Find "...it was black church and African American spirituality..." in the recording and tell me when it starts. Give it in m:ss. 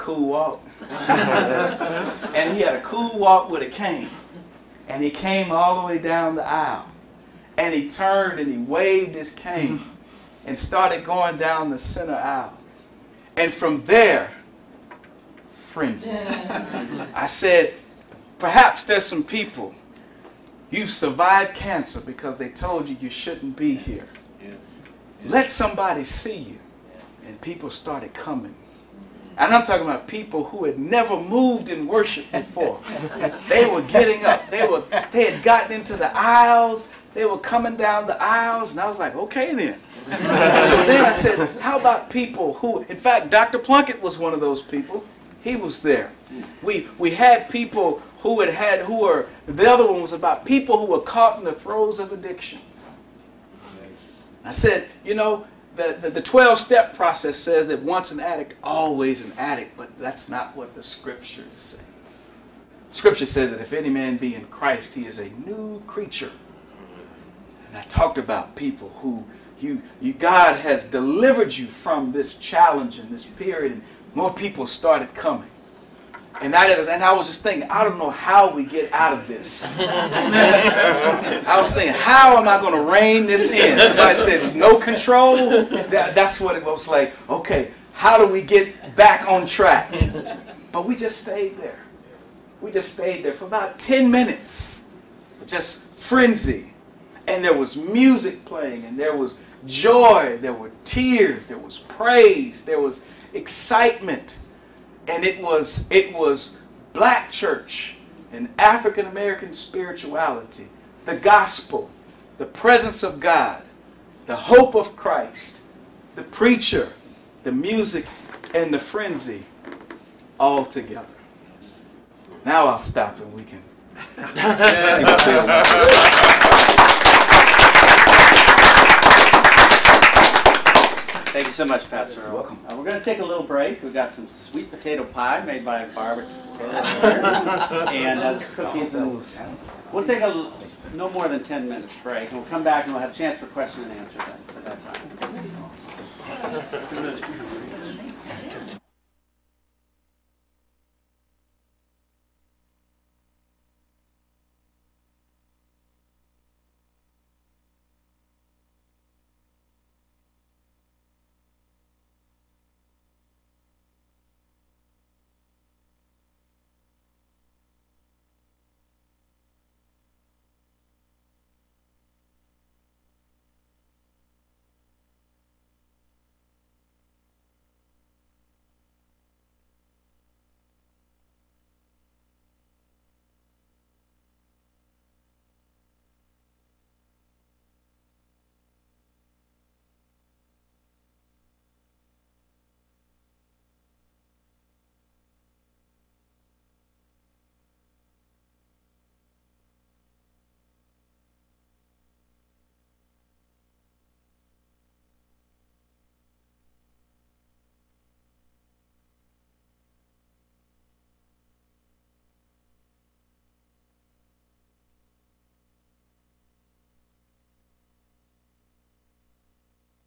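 1:45.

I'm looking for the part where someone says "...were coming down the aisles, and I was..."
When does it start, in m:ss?
0:37.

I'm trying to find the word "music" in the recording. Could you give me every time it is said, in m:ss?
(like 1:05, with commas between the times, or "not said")
1:37, 1:57.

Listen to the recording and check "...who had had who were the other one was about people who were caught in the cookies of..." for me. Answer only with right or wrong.
wrong.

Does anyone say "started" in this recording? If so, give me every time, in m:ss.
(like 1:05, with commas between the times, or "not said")
0:10, 0:27, 1:14.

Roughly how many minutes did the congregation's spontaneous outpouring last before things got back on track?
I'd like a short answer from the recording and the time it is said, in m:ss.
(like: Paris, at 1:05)
10 minutes, at 1:33.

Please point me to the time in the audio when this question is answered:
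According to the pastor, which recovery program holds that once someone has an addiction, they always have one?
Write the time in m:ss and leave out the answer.
0:56.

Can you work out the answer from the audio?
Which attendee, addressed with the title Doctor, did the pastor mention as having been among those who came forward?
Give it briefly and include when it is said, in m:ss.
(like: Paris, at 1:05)
Dr. Plunkett, at 0:43.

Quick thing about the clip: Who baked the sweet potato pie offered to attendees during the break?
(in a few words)
Barbara.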